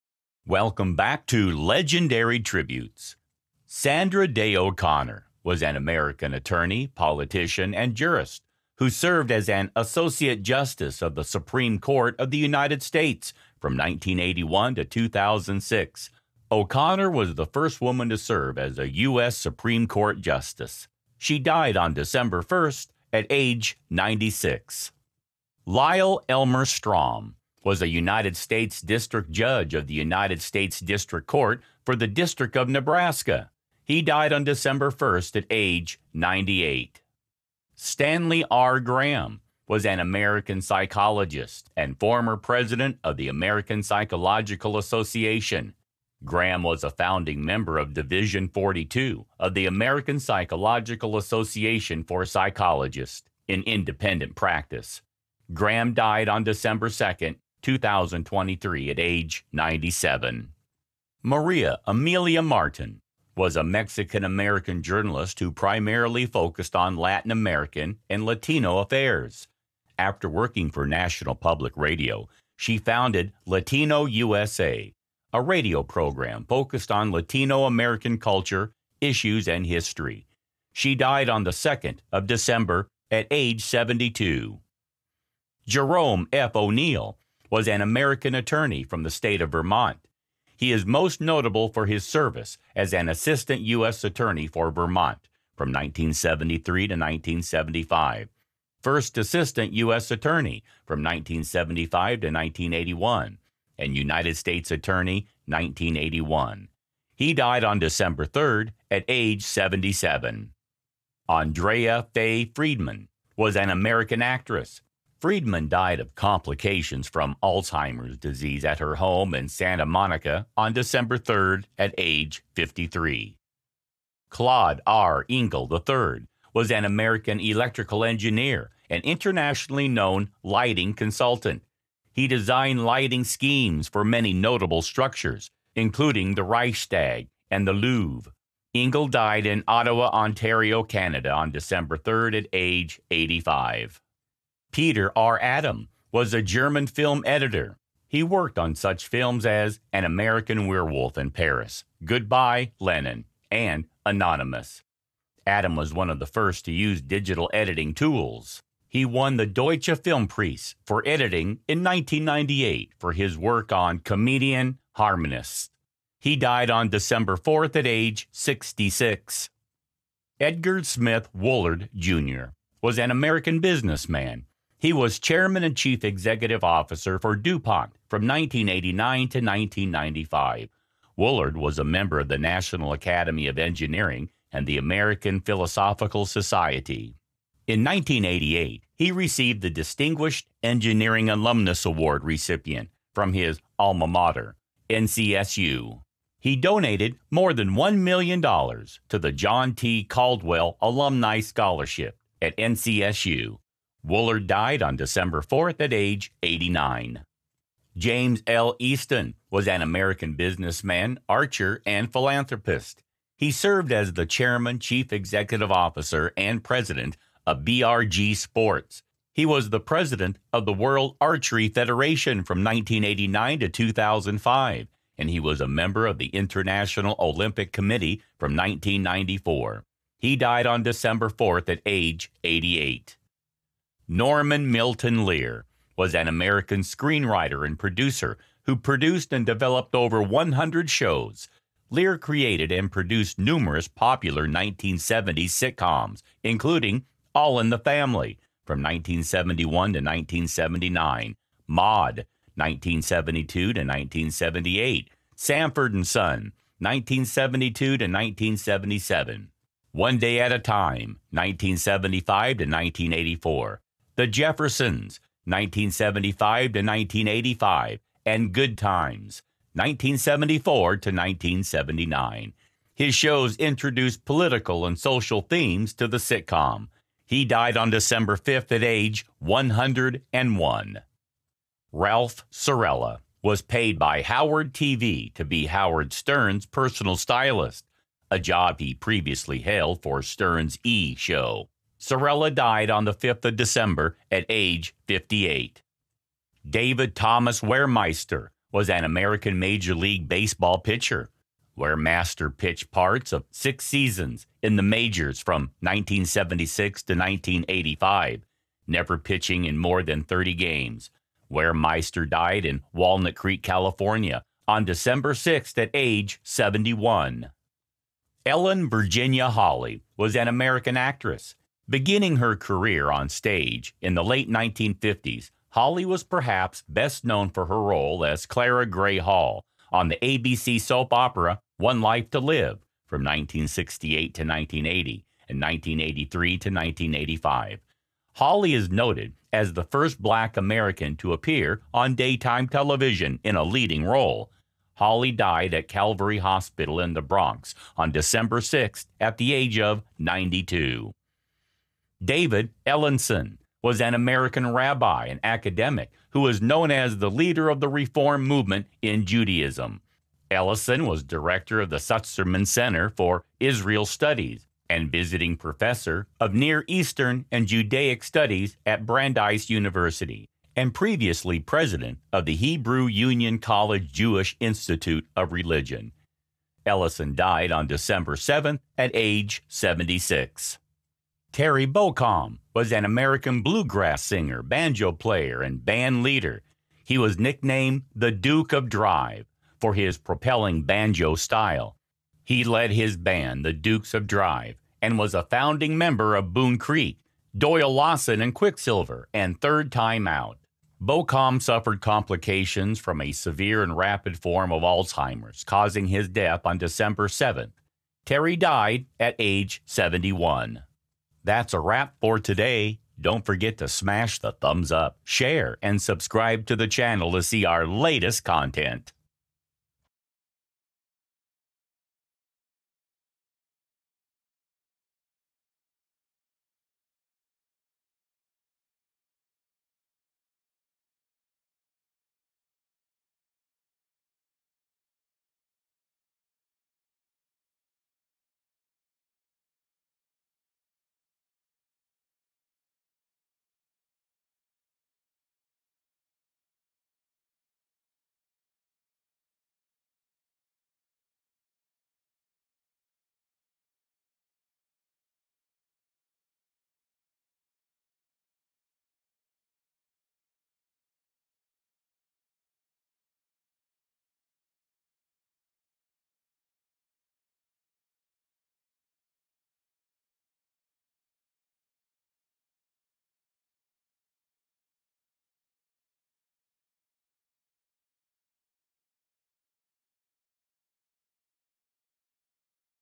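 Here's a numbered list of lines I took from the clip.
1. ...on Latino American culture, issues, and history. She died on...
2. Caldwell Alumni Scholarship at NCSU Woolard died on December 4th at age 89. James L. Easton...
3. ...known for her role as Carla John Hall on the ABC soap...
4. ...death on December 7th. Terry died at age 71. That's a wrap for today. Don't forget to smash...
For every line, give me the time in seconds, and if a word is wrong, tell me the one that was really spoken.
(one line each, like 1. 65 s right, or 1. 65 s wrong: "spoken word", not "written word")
1. 76 s right
2. 200 s right
3. 327 s wrong: "Gray", not "John"
4. 406 s right.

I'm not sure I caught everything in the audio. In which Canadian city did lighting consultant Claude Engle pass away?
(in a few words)
Ottawa.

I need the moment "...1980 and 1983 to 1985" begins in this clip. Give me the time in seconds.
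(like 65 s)
334 s.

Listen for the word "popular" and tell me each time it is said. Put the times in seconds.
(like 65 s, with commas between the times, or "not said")
243 s.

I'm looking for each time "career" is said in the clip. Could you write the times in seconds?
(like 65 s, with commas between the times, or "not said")
322 s.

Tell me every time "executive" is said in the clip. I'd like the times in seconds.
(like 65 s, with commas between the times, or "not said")
176 s, 215 s.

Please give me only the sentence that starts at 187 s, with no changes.
In 1988, he received the Distinguished Engineering Alumnus Award recipient from his alma mater, NCSU.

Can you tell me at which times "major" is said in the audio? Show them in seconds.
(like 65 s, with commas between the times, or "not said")
299 s, 304 s.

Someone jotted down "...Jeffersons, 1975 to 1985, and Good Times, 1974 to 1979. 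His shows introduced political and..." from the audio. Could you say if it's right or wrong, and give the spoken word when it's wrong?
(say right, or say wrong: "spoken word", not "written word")
right.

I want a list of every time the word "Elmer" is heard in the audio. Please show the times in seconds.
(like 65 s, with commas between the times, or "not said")
26 s.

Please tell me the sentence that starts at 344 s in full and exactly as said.
Holly died at Calvary Hospital in the Bronx on December 6 at the age of 92.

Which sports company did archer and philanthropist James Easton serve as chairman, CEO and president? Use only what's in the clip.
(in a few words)
BRG Sports.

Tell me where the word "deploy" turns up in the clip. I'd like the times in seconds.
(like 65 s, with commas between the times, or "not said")
not said.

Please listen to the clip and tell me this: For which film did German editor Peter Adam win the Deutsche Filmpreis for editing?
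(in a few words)
Comedian Harmonists.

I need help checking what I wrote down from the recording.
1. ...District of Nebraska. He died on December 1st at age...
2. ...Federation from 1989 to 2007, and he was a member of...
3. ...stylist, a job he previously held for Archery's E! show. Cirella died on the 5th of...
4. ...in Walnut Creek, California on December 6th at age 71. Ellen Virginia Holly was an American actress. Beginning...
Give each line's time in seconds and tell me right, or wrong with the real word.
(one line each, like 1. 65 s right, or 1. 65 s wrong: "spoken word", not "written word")
1. 32 s right
2. 221 s wrong: "2005", not "2007"
3. 287 s wrong: "Stern", not "Archery"
4. 312 s right.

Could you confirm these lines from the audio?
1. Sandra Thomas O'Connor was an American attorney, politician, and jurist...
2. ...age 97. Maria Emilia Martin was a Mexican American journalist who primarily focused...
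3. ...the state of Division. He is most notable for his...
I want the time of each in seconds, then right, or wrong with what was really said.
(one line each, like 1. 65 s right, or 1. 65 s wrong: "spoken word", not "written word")
1. 3 s wrong: "Day", not "Thomas"
2. 58 s right
3. 89 s wrong: "Vermont", not "Division".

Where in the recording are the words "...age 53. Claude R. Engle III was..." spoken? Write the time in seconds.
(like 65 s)
121 s.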